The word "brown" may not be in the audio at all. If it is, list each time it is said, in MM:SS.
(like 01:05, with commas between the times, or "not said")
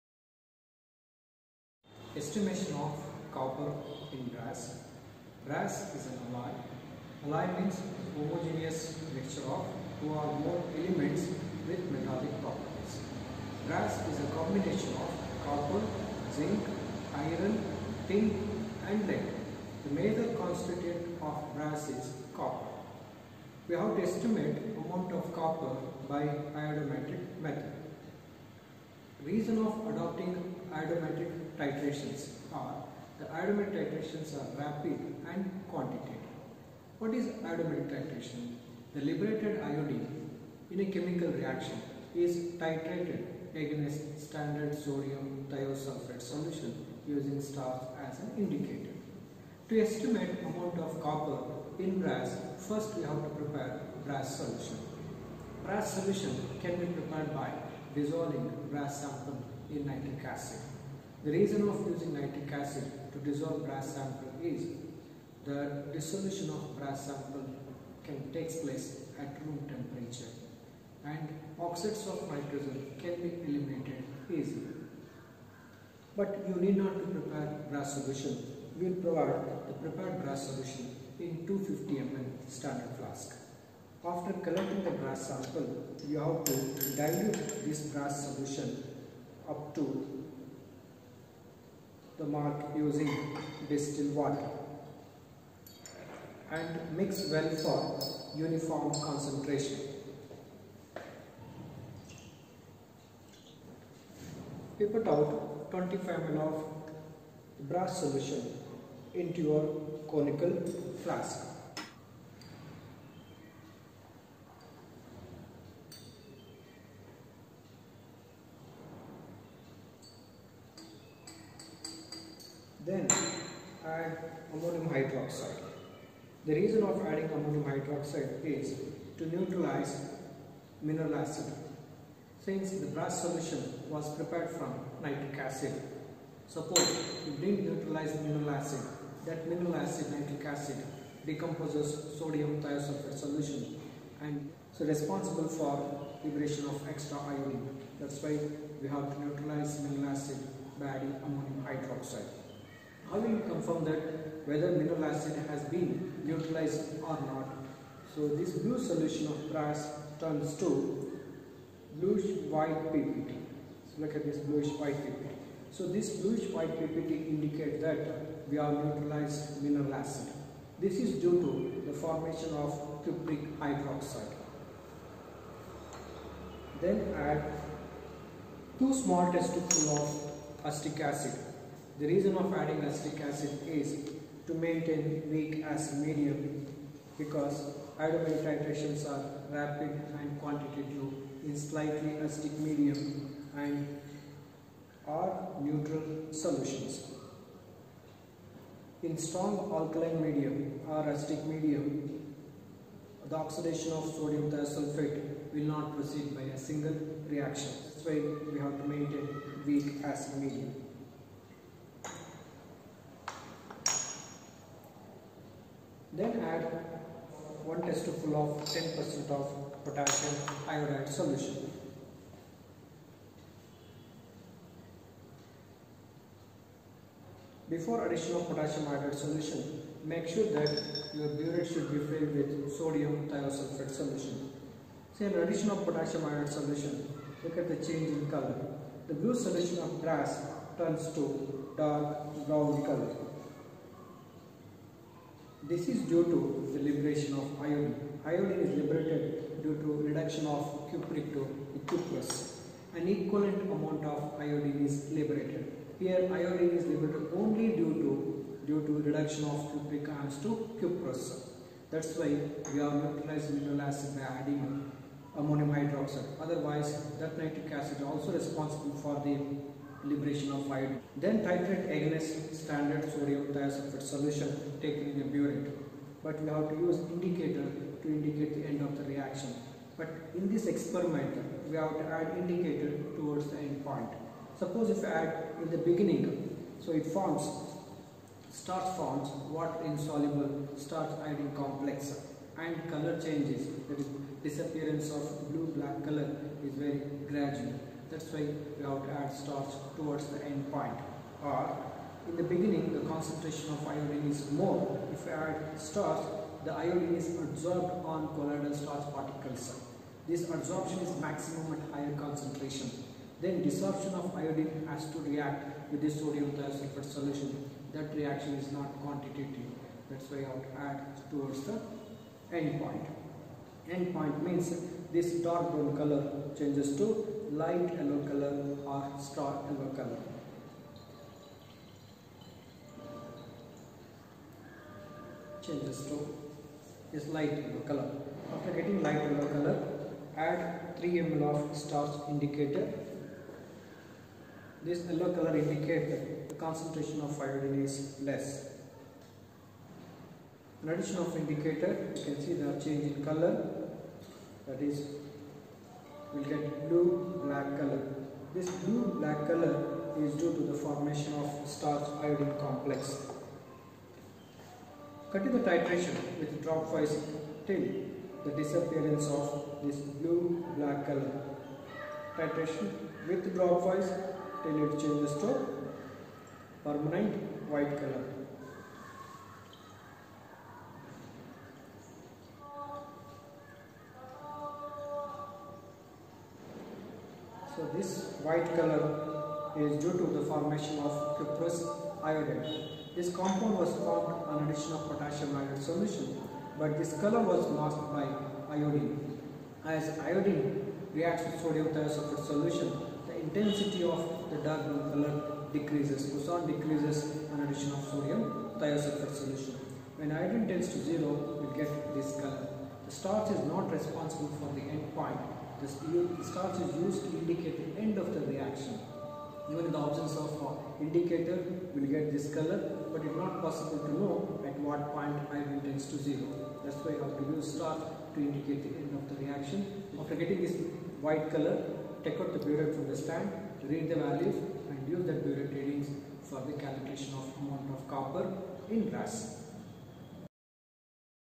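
04:02, 05:25.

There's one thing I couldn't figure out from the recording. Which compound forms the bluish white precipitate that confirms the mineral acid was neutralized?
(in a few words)
cupric hydroxide.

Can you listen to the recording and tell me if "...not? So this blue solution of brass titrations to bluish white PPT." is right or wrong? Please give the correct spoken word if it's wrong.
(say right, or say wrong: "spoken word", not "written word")
wrong: "turns", not "titrations".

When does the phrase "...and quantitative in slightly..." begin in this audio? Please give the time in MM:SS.
03:10.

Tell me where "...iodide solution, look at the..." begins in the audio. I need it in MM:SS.
03:56.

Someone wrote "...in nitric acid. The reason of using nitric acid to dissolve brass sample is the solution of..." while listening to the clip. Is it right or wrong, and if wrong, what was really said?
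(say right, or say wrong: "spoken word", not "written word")
wrong: "dissolution", not "solution".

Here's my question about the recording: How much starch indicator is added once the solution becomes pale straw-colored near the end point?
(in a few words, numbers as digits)
3 ml.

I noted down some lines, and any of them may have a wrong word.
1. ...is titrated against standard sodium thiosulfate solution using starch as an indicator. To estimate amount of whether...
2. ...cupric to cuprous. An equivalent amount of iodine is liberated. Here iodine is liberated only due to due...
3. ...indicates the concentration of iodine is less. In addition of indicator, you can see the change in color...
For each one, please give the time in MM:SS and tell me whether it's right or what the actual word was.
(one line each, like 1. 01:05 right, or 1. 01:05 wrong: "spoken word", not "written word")
1. 00:42 wrong: "copper", not "whether"
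2. 04:10 right
3. 05:45 right.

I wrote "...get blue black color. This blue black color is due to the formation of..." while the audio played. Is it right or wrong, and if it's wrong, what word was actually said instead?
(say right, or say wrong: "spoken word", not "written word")
right.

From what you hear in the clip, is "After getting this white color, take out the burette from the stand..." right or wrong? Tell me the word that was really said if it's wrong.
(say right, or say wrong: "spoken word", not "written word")
right.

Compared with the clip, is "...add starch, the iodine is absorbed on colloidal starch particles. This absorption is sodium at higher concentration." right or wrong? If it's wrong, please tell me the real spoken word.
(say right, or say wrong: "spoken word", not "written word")
wrong: "maximum", not "sodium".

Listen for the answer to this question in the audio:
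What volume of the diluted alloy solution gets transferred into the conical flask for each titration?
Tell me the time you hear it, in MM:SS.
01:45.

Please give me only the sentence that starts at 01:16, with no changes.
But you need not to prepare brass solution.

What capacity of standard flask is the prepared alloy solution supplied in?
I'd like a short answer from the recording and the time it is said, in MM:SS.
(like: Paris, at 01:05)
250 ml, at 01:21.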